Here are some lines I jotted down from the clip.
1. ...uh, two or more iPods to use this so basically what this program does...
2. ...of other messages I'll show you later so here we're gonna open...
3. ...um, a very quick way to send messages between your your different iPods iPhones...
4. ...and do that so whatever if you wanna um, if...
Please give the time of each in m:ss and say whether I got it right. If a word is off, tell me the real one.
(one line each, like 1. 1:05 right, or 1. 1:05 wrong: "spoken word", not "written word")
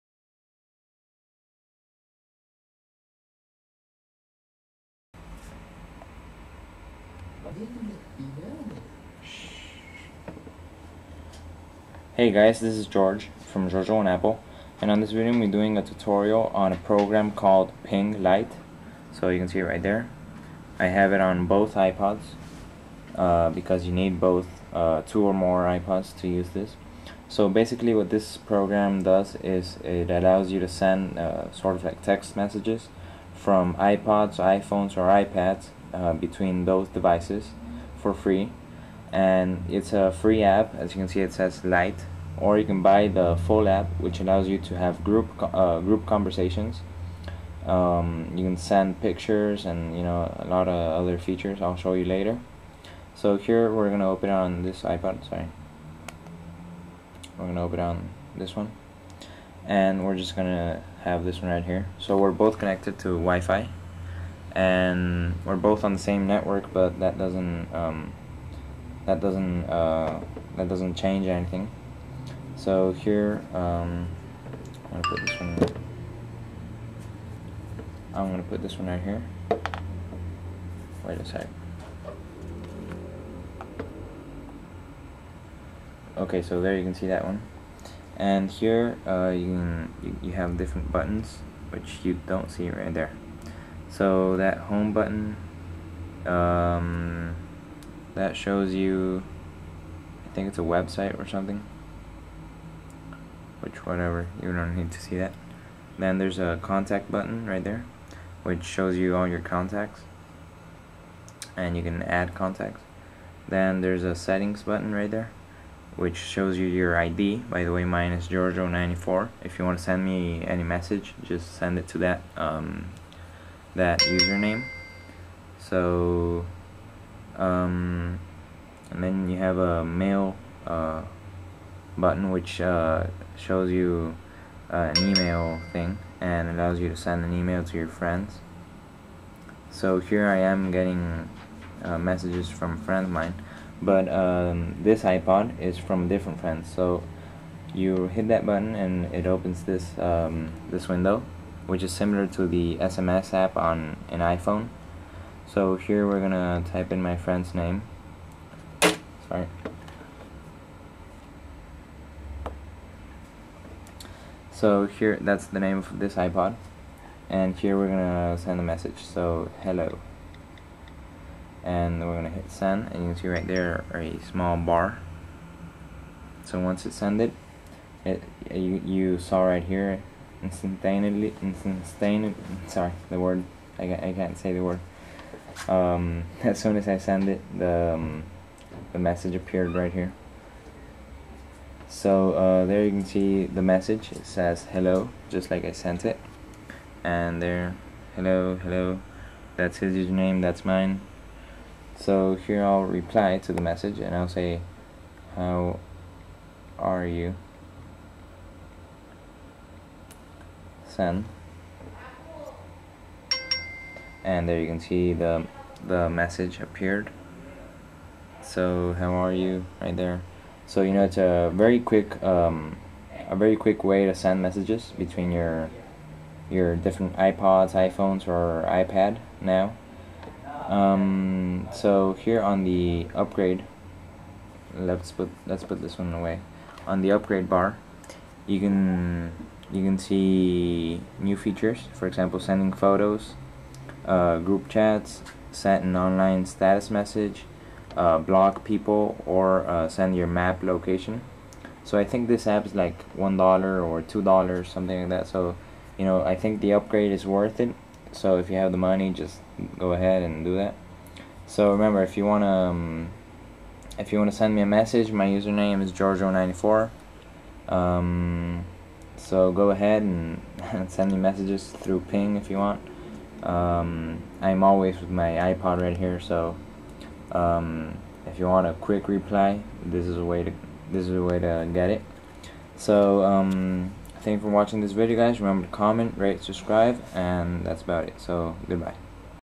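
1. 0:24 right
2. 0:50 wrong: "features", not "messages"
3. 3:42 right
4. 4:20 wrong: "remember", not "whatever".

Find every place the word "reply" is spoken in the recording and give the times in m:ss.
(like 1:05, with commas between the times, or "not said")
3:22, 4:39.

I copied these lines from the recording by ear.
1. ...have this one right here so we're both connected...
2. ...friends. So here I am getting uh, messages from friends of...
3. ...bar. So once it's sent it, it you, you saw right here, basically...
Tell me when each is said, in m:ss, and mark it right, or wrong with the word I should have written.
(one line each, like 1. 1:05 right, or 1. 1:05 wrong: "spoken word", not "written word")
1. 1:01 right
2. 2:17 right
3. 2:54 wrong: "instantaneously", not "basically".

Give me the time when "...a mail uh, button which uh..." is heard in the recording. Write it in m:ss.
2:09.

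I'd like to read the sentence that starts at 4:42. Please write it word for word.
So um, thank you for watching this video, guys.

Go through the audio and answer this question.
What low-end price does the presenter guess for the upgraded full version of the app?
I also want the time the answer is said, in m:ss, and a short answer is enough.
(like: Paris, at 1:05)
$1, at 4:13.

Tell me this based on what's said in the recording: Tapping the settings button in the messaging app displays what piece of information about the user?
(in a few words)
your ID.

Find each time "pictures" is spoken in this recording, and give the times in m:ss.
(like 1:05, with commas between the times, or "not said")
0:49.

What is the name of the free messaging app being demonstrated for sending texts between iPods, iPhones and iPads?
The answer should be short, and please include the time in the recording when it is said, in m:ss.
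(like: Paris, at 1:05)
Ping Lite, at 0:17.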